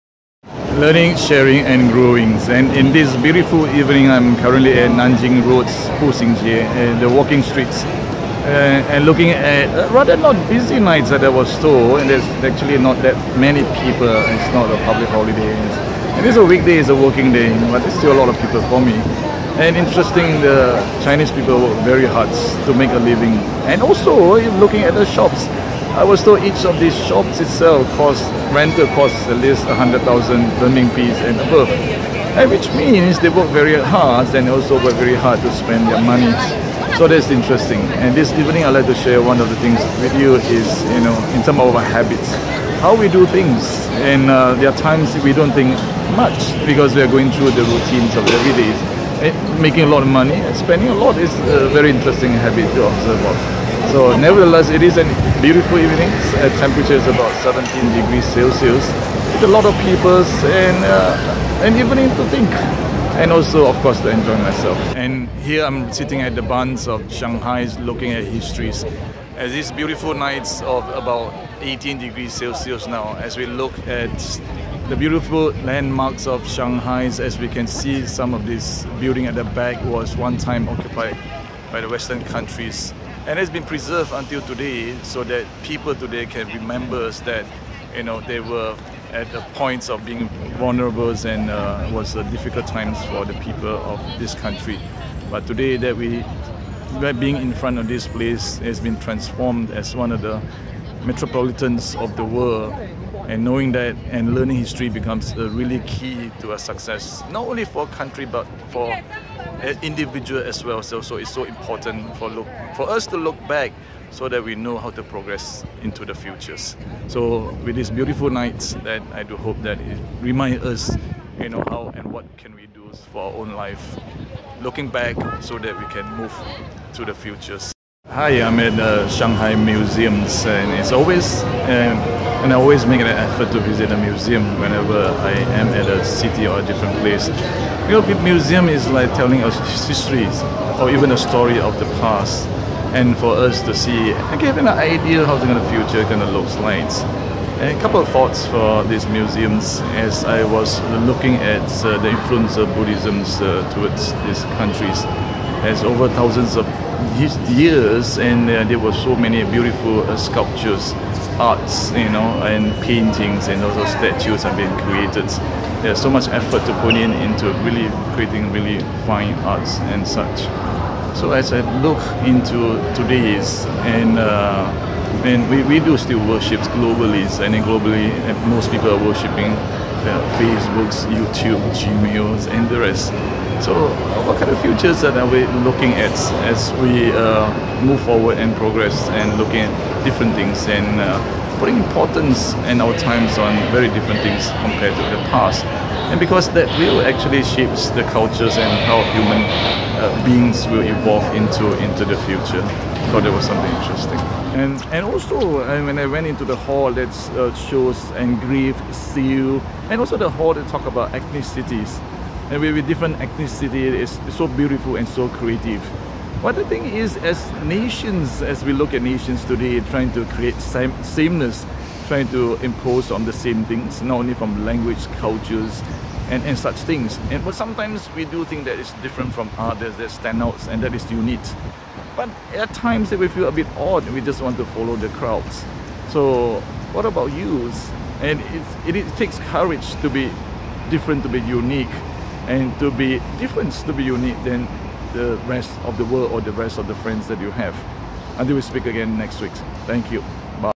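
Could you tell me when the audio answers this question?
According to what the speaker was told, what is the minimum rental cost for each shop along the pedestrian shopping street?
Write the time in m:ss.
0:29.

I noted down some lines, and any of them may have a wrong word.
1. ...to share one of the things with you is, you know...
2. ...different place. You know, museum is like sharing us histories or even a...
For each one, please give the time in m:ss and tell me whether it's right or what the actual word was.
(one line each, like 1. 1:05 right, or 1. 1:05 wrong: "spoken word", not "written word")
1. 0:38 right
2. 2:16 wrong: "telling", not "sharing".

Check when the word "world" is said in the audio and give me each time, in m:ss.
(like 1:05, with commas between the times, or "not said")
1:42, 4:06.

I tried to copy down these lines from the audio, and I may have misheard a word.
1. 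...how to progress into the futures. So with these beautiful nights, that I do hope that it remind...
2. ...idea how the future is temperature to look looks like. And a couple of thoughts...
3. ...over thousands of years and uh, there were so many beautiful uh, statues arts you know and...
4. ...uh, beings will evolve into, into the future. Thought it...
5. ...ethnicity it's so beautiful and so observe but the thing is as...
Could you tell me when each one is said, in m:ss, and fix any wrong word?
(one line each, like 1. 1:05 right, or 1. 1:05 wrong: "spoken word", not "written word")
1. 1:54 right
2. 2:24 wrong: "future", not "temperature"
3. 2:35 wrong: "sculptures", not "statues"
4. 3:20 right
5. 3:33 wrong: "creative", not "observe".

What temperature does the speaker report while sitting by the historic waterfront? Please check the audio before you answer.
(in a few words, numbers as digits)
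18 degrees Celsius.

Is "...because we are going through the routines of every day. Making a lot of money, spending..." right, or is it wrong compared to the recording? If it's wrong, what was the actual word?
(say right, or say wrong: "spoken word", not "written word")
right.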